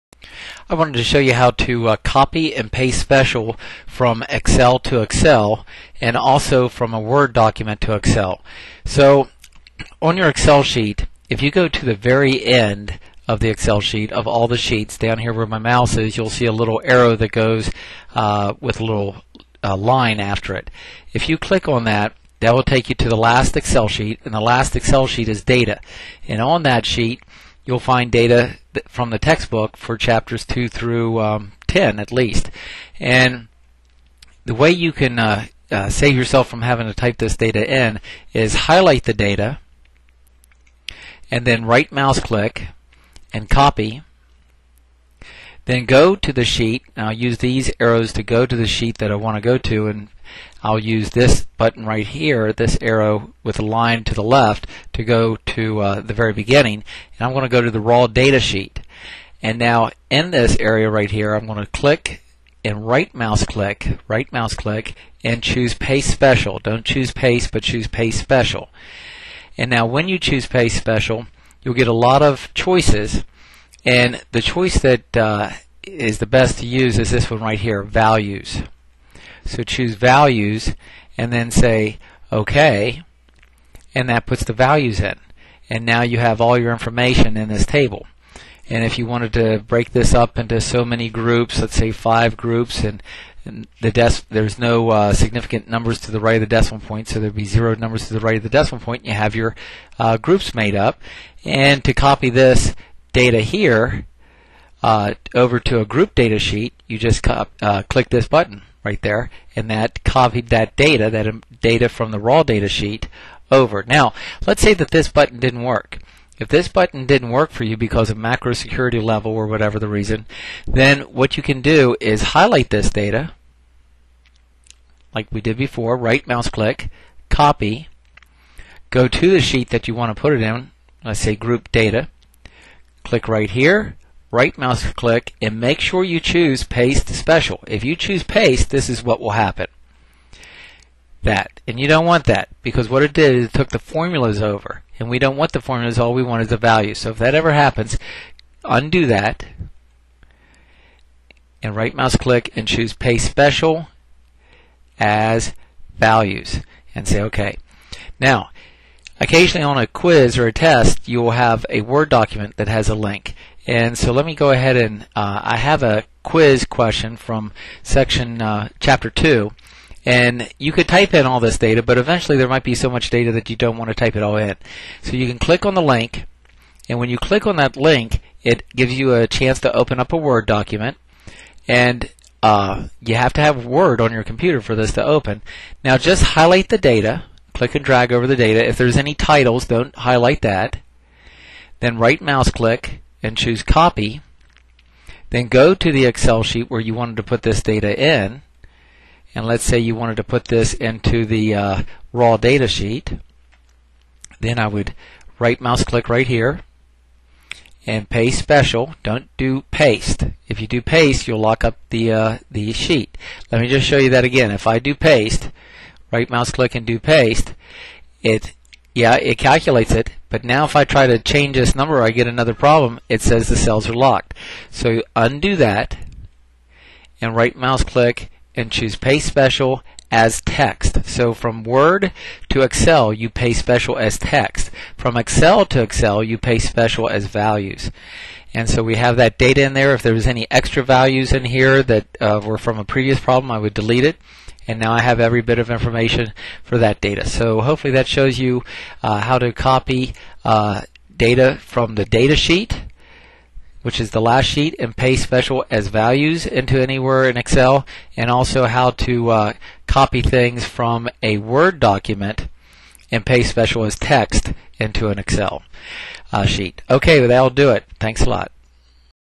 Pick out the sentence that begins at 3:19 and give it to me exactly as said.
And let's say you wanted to put this into the uh, raw data sheet.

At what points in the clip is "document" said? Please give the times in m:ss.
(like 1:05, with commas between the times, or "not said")
0:07, 2:42, 3:00, 4:21.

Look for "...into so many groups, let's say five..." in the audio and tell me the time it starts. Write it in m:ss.
1:30.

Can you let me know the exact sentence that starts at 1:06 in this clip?
Don't choose Paste, but choose Paste Special.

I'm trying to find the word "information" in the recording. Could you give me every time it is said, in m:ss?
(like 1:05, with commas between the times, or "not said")
1:26, 4:05.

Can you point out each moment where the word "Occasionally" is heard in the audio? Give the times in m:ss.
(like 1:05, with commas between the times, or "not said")
2:39.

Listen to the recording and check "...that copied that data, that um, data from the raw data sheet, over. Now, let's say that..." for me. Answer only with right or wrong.
right.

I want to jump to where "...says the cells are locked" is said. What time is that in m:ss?
3:43.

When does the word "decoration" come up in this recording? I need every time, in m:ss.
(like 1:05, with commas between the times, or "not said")
not said.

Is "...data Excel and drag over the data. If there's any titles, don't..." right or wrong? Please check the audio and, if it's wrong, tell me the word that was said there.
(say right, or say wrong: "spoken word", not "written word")
wrong: "Click", not "Excel".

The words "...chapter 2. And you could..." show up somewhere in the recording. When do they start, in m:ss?
2:48.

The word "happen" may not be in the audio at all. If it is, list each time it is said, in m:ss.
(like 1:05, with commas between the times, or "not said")
2:19, 2:27.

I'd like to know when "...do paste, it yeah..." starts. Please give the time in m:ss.
3:36.